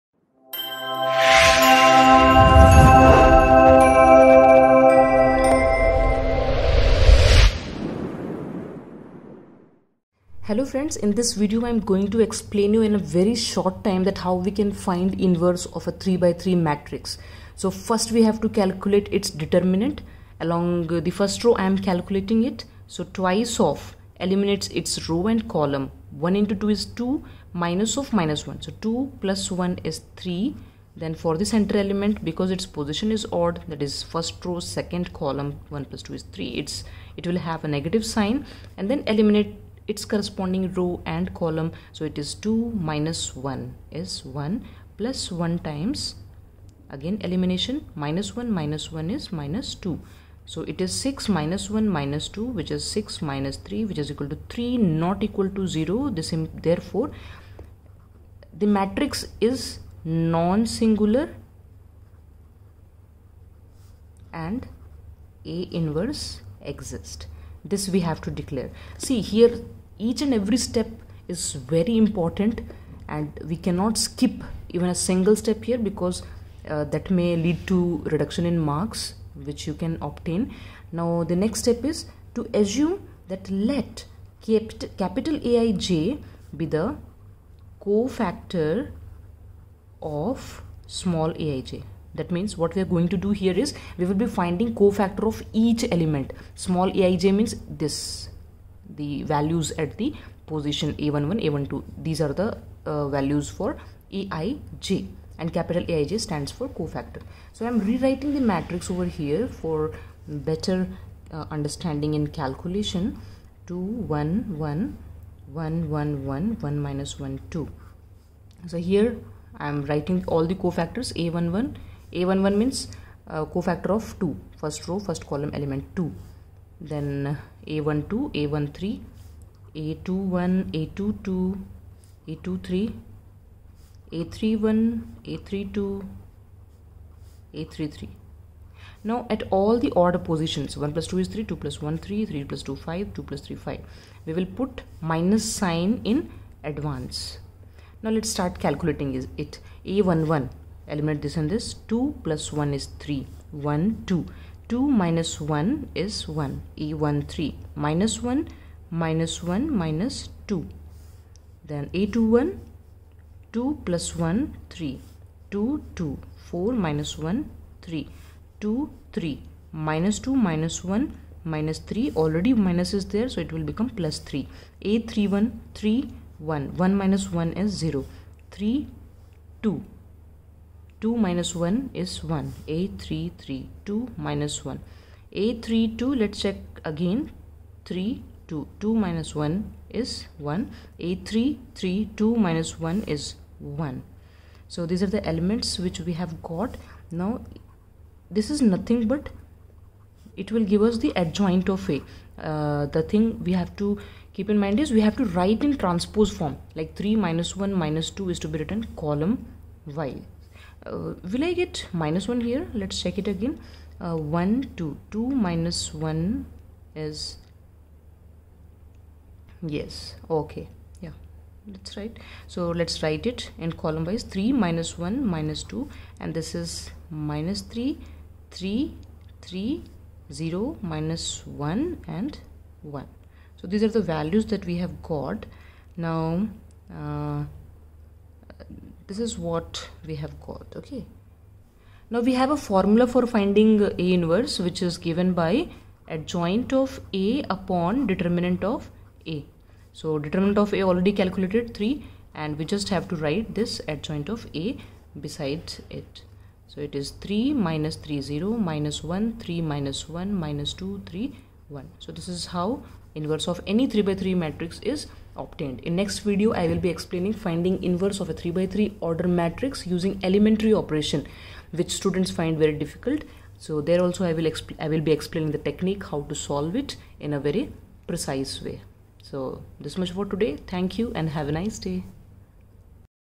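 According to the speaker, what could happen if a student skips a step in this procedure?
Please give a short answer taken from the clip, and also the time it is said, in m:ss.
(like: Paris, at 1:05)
reduction in marks, at 1:18.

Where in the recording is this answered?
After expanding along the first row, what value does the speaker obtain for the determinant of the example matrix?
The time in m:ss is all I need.
0:53.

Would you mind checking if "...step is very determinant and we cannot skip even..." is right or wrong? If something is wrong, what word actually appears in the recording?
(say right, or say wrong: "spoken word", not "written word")
wrong: "important", not "determinant".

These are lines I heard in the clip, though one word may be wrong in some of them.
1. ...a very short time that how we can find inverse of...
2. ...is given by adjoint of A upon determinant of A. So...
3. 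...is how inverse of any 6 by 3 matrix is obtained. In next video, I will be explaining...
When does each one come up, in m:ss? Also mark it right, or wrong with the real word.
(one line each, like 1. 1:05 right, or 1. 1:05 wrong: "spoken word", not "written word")
1. 0:12 right
2. 4:04 right
3. 4:22 wrong: "3", not "6".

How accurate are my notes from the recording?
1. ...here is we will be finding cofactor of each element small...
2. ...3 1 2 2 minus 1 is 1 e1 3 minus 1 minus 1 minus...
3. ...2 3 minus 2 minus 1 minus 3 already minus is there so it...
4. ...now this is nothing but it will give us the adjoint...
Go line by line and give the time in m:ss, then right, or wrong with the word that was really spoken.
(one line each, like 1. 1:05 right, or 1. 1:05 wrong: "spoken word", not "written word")
1. 1:33 right
2. 2:33 right
3. 2:48 right
4. 3:17 right.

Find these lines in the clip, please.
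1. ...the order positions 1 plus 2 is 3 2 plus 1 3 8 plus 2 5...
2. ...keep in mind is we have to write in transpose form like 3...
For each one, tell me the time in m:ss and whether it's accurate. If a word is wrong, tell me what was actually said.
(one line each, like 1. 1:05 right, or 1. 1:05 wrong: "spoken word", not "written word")
1. 2:19 wrong: "3", not "8"
2. 3:24 right.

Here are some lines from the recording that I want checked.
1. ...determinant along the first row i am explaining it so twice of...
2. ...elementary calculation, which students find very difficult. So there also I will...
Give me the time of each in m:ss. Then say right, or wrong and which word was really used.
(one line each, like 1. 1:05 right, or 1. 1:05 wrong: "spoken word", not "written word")
1. 0:19 wrong: "calculating", not "explaining"
2. 4:30 wrong: "operation", not "calculation".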